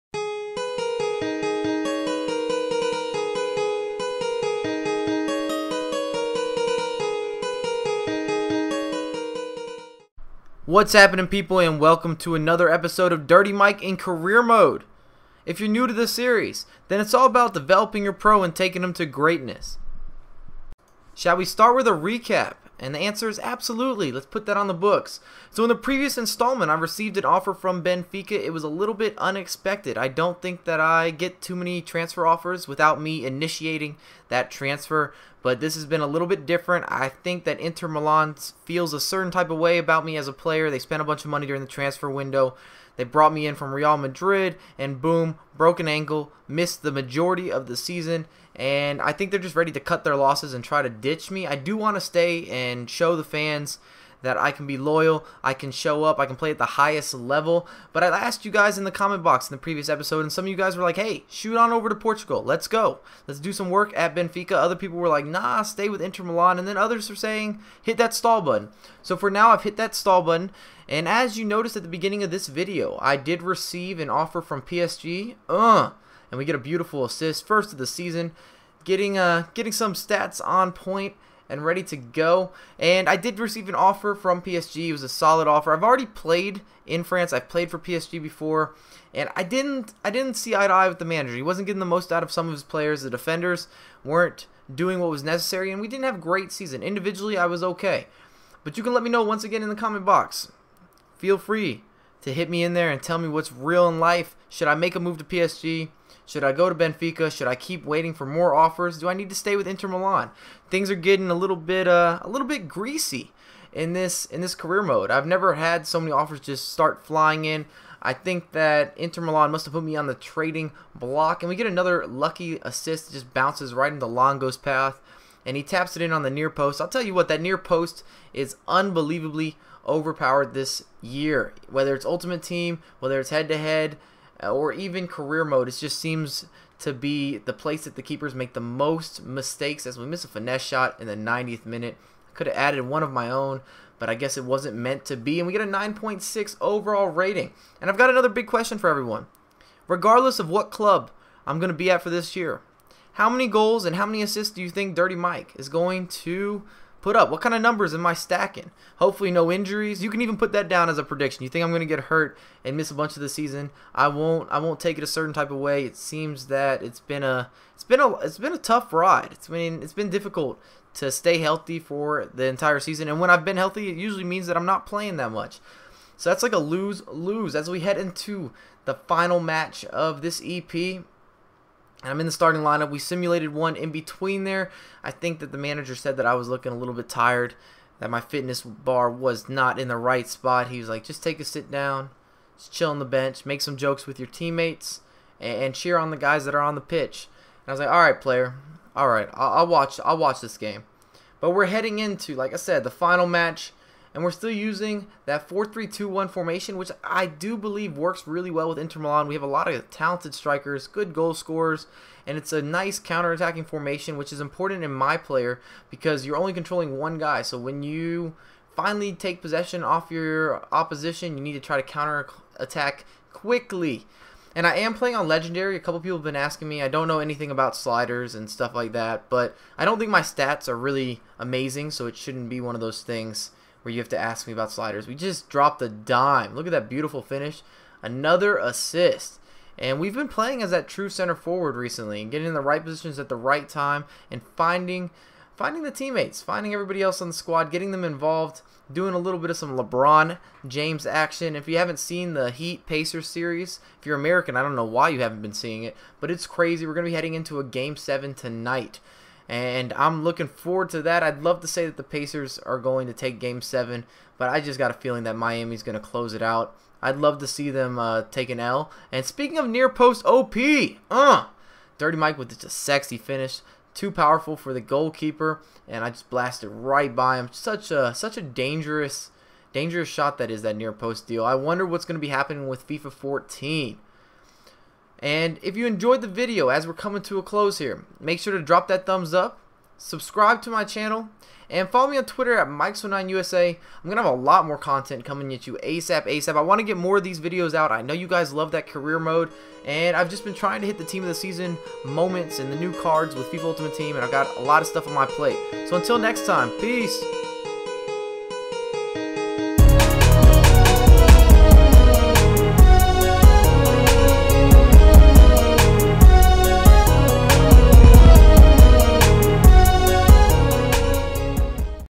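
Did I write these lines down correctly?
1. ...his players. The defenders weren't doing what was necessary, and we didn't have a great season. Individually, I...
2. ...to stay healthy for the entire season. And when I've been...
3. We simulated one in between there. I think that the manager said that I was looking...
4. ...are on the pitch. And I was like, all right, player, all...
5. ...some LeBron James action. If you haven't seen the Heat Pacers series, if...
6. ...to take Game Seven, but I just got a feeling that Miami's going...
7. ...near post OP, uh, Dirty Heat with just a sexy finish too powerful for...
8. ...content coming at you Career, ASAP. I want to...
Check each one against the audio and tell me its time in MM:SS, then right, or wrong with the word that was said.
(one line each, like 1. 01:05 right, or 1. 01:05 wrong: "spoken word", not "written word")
1. 01:32 right
2. 02:50 right
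3. 03:02 right
4. 03:16 right
5. 04:09 right
6. 04:23 right
7. 04:29 wrong: "Mike", not "Heat"
8. 04:54 wrong: "ASAP", not "Career".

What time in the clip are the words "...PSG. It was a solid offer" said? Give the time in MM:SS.
01:24.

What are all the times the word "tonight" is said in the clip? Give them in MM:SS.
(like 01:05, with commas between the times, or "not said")
04:18.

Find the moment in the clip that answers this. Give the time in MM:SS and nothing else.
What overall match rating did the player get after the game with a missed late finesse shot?
02:25.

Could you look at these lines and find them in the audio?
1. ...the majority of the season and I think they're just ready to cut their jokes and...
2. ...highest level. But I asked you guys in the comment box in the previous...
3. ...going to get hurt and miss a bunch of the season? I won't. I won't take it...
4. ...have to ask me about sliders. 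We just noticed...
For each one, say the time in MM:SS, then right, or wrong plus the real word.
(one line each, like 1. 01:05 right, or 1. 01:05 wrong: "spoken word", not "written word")
1. 00:46 wrong: "losses", not "jokes"
2. 00:56 right
3. 02:41 right
4. 03:53 wrong: "dropped", not "noticed".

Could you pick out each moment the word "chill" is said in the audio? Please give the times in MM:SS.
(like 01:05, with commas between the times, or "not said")
03:12.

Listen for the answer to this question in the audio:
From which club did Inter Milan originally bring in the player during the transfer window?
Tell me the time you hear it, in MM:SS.
00:43.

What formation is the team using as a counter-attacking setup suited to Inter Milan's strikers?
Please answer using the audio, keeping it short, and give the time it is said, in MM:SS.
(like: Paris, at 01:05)
4-3-2-1, at 03:25.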